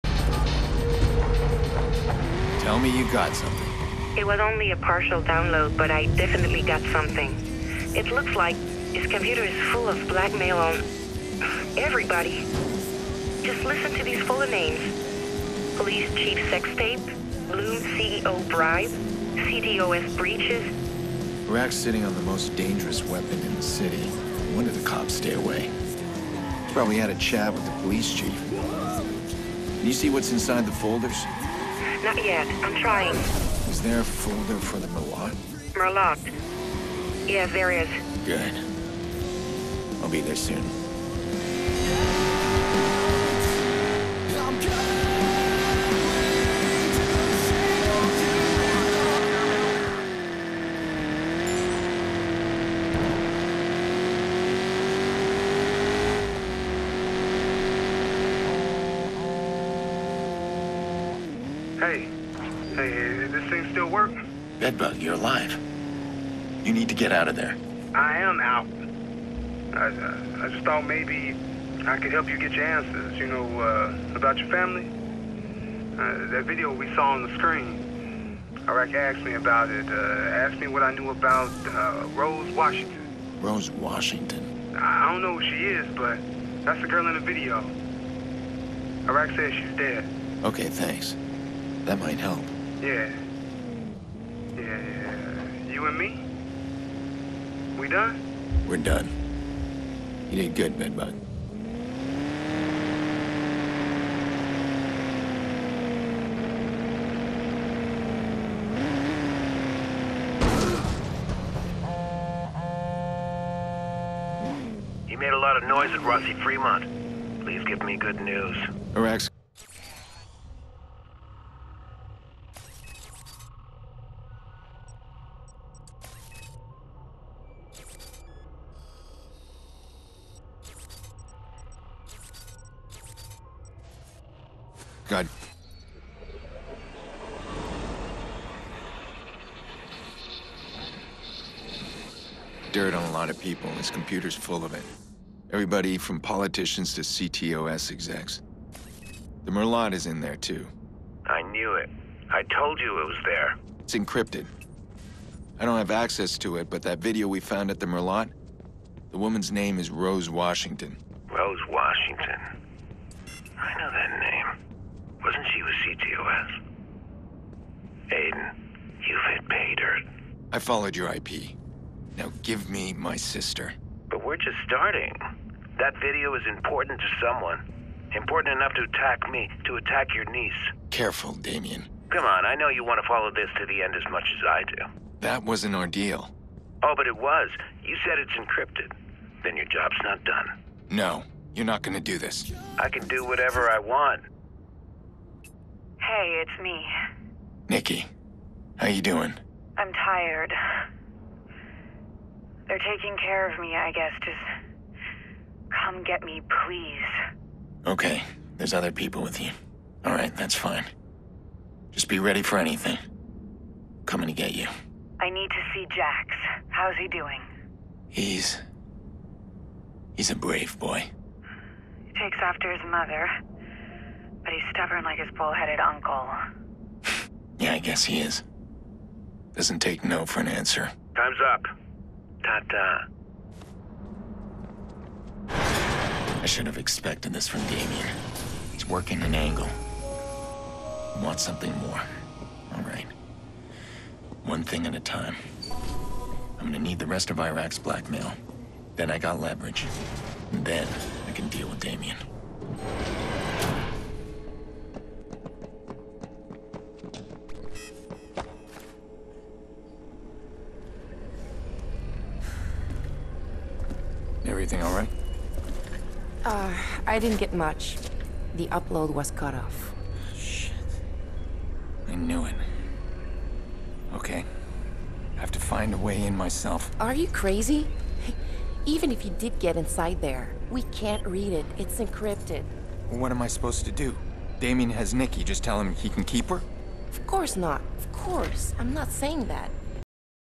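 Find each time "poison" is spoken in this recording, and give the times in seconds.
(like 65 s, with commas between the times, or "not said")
not said.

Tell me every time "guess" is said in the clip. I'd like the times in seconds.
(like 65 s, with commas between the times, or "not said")
203 s, 227 s.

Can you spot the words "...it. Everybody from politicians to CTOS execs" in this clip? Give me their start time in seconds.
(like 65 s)
144 s.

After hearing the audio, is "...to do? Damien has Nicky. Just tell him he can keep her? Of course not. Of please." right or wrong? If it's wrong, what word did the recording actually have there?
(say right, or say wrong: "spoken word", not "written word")
wrong: "course", not "please".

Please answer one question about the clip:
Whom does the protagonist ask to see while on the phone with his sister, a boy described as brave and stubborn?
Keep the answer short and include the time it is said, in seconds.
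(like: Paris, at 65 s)
Jax, at 215 s.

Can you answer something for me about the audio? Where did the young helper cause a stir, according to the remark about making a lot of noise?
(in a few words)
Rossi Fremont.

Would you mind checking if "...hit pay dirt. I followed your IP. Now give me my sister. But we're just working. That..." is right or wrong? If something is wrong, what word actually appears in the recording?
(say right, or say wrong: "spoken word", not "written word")
wrong: "starting", not "working".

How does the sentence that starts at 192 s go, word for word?
I can do whatever I want.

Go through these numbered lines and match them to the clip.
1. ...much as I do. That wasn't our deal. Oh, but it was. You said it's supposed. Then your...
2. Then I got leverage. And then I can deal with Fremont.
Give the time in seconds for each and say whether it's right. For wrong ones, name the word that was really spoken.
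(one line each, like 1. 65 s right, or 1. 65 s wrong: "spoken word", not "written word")
1. 184 s wrong: "encrypted", not "supposed"
2. 248 s wrong: "Damien", not "Fremont".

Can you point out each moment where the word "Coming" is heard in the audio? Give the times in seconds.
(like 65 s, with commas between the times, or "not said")
214 s.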